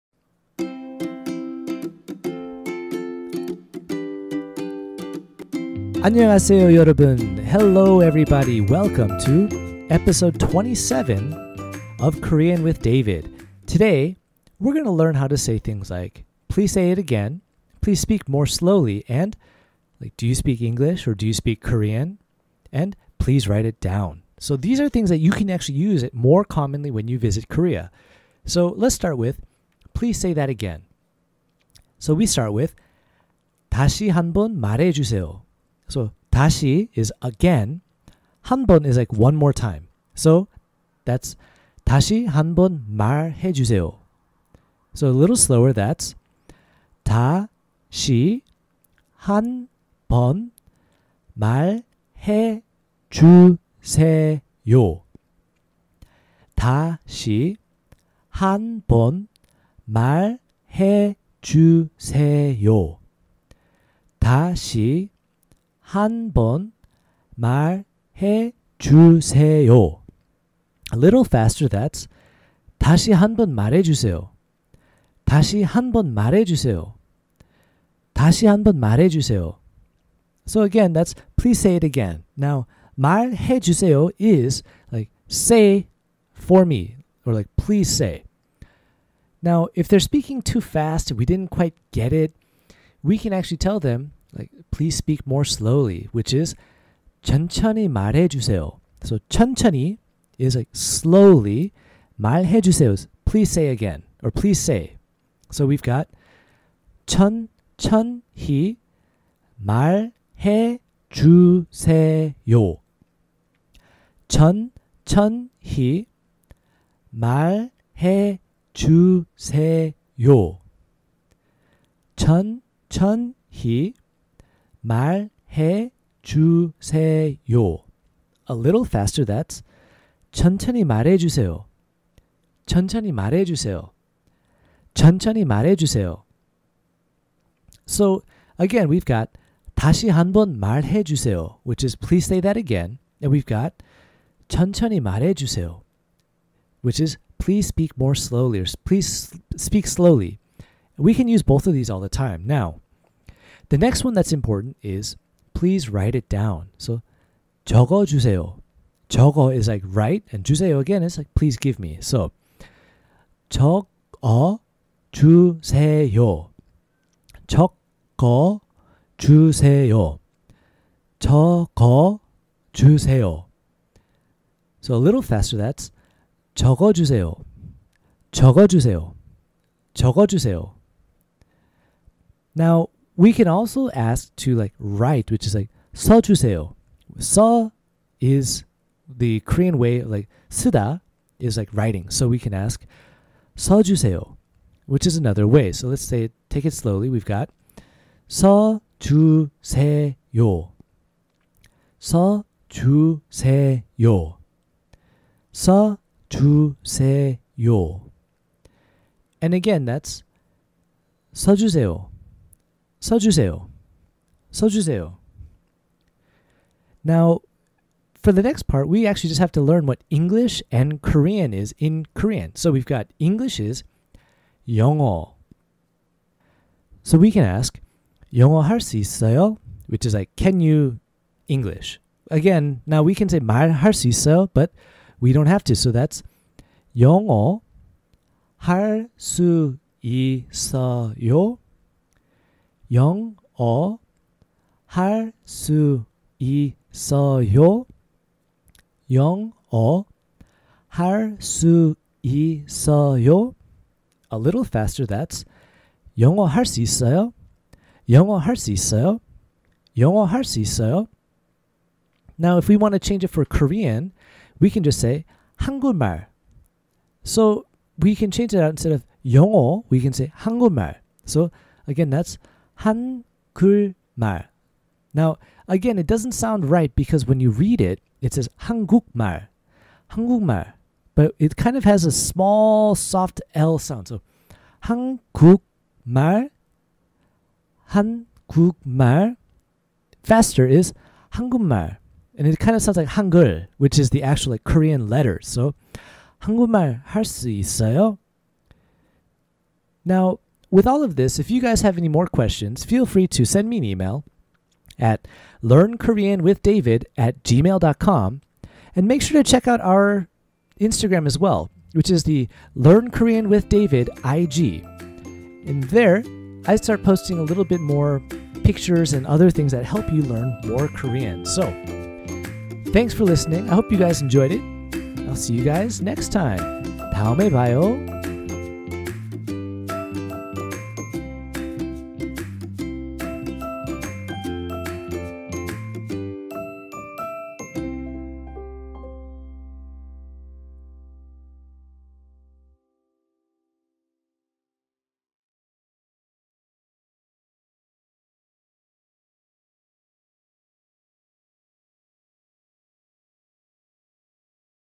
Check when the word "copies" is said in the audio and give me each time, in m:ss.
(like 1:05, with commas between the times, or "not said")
not said.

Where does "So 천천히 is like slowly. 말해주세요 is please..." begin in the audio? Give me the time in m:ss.
1:39.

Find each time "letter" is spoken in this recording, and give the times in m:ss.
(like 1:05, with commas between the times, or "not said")
4:55.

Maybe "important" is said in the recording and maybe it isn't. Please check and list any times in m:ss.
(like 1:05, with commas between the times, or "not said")
2:34.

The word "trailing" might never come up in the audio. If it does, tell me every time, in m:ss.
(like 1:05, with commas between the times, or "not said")
not said.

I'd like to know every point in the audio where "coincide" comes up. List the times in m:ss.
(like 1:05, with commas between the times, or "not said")
not said.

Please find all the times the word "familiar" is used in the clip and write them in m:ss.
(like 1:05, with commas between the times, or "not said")
not said.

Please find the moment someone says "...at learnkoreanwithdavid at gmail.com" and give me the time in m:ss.
5:04.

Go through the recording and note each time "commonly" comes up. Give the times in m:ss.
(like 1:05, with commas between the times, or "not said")
0:26.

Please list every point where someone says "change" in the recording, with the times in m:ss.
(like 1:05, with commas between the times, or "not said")
4:22, 4:28.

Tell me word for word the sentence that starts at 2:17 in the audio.
So again, we've got 다시 한 번 말해 주세요, which is please say that again.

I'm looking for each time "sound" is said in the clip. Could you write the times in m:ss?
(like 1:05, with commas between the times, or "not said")
4:36, 4:43, 4:52.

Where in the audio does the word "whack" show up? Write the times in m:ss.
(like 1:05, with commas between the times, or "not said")
not said.